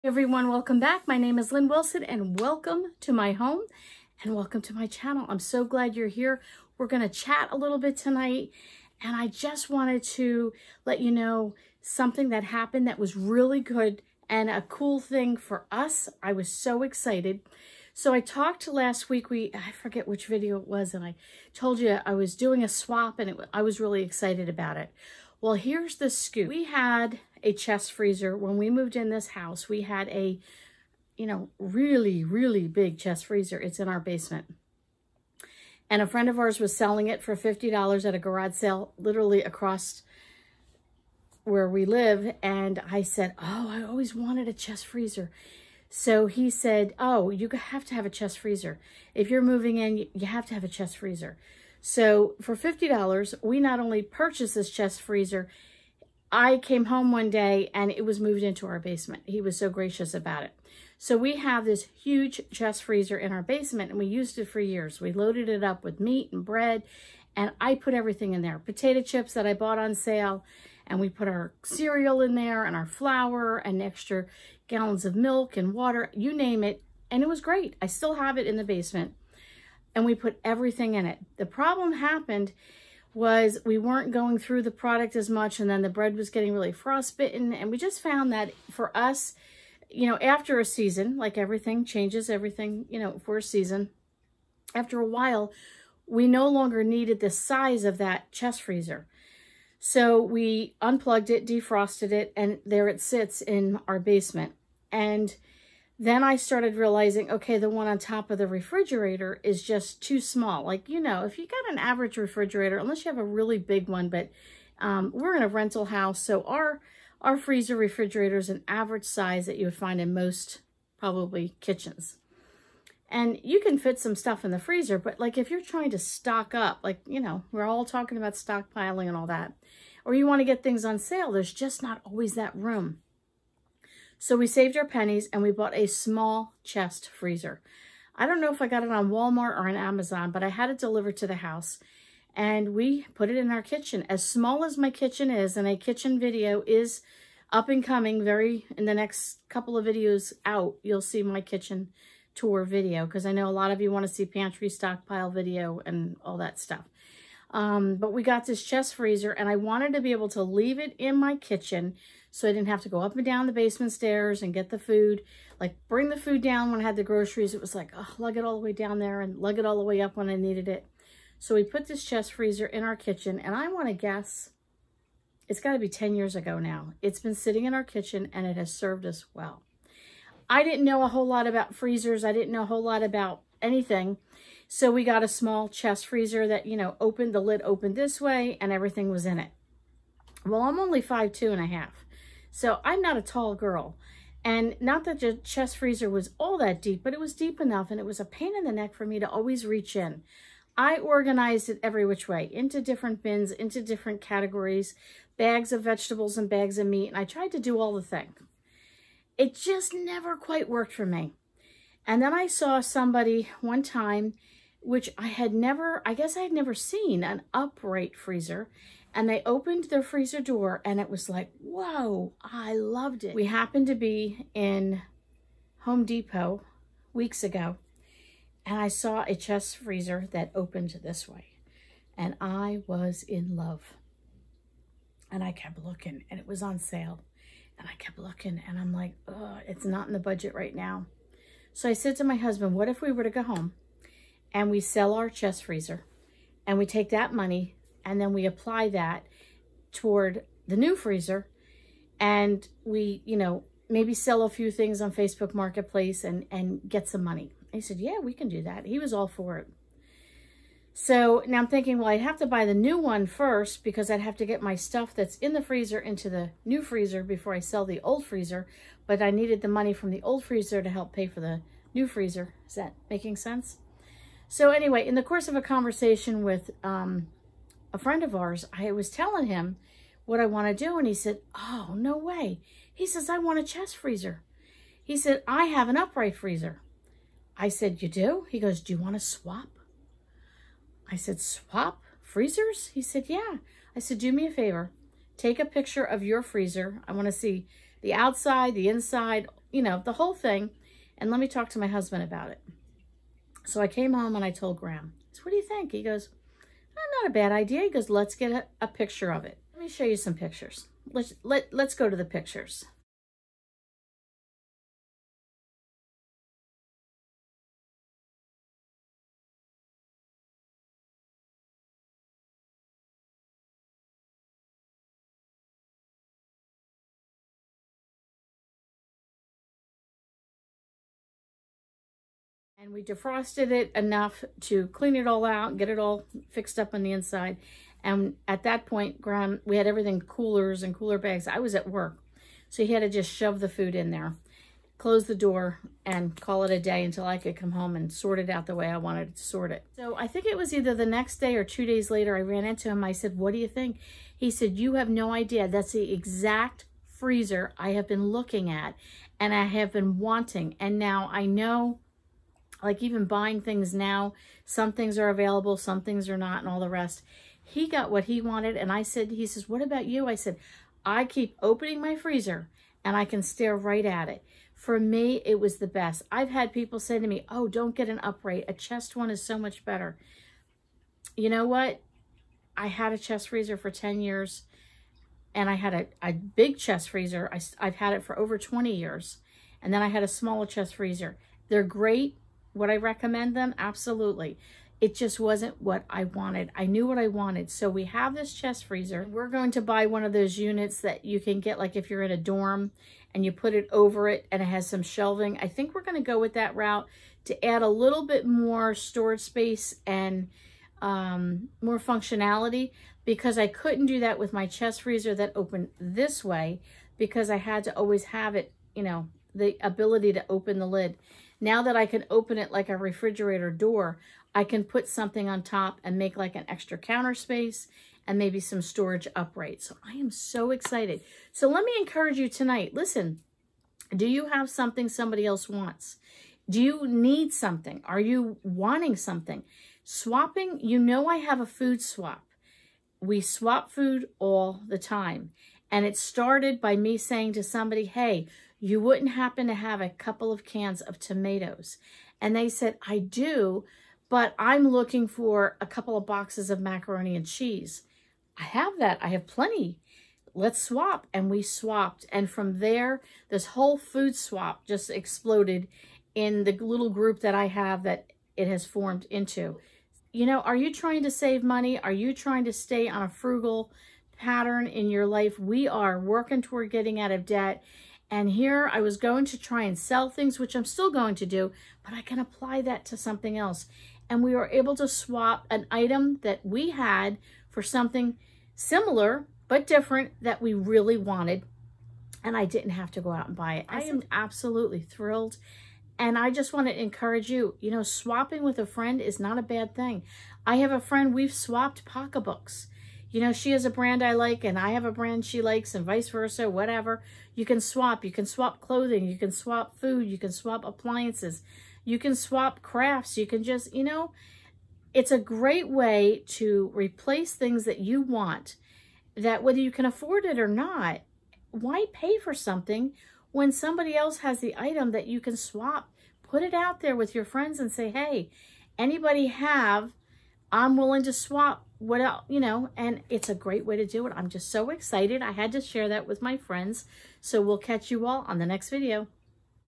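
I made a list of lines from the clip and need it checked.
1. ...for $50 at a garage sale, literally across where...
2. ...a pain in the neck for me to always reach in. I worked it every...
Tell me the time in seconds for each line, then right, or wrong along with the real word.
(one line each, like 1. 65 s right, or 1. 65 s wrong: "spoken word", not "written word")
1. 37 s right
2. 198 s wrong: "organized", not "worked".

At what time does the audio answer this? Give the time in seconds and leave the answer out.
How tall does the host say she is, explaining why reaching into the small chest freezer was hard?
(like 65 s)
191 s.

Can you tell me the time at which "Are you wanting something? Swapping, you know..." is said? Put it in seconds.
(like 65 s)
438 s.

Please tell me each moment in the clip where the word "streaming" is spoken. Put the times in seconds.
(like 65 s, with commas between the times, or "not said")
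not said.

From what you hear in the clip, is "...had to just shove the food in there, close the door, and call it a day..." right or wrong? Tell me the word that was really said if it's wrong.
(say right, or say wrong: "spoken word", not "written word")
right.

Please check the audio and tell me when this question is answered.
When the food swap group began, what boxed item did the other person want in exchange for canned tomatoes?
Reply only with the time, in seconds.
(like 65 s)
456 s.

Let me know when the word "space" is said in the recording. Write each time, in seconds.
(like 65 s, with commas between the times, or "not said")
409 s, 427 s.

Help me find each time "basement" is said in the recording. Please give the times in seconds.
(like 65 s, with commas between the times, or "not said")
33 s, 58 s, 63 s, 78 s, 103 s, 163 s.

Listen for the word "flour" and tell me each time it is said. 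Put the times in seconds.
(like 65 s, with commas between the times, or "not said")
72 s.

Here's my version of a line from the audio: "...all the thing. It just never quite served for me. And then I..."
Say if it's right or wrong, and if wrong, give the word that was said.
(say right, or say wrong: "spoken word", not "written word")
wrong: "worked", not "served".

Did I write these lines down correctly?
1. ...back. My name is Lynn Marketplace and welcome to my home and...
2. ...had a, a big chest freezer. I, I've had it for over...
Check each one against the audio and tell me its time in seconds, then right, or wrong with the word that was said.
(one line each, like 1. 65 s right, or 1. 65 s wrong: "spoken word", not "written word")
1. 0 s wrong: "Wilson", not "Marketplace"
2. 385 s right.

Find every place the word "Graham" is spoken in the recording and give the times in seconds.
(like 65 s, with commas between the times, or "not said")
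304 s, 339 s.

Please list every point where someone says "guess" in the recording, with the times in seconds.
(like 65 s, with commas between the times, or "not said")
173 s, 216 s.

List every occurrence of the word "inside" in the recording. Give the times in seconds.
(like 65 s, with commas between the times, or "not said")
298 s, 337 s.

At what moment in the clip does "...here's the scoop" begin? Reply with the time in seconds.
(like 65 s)
25 s.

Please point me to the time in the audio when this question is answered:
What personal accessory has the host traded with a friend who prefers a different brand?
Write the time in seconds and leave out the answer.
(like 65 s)
502 s.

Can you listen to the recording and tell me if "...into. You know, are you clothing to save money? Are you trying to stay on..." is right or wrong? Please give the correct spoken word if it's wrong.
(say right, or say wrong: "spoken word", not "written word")
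wrong: "trying", not "clothing".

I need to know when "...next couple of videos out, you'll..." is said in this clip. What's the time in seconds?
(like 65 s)
148 s.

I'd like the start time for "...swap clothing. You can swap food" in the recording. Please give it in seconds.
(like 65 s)
508 s.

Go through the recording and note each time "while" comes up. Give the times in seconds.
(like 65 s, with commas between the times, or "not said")
95 s.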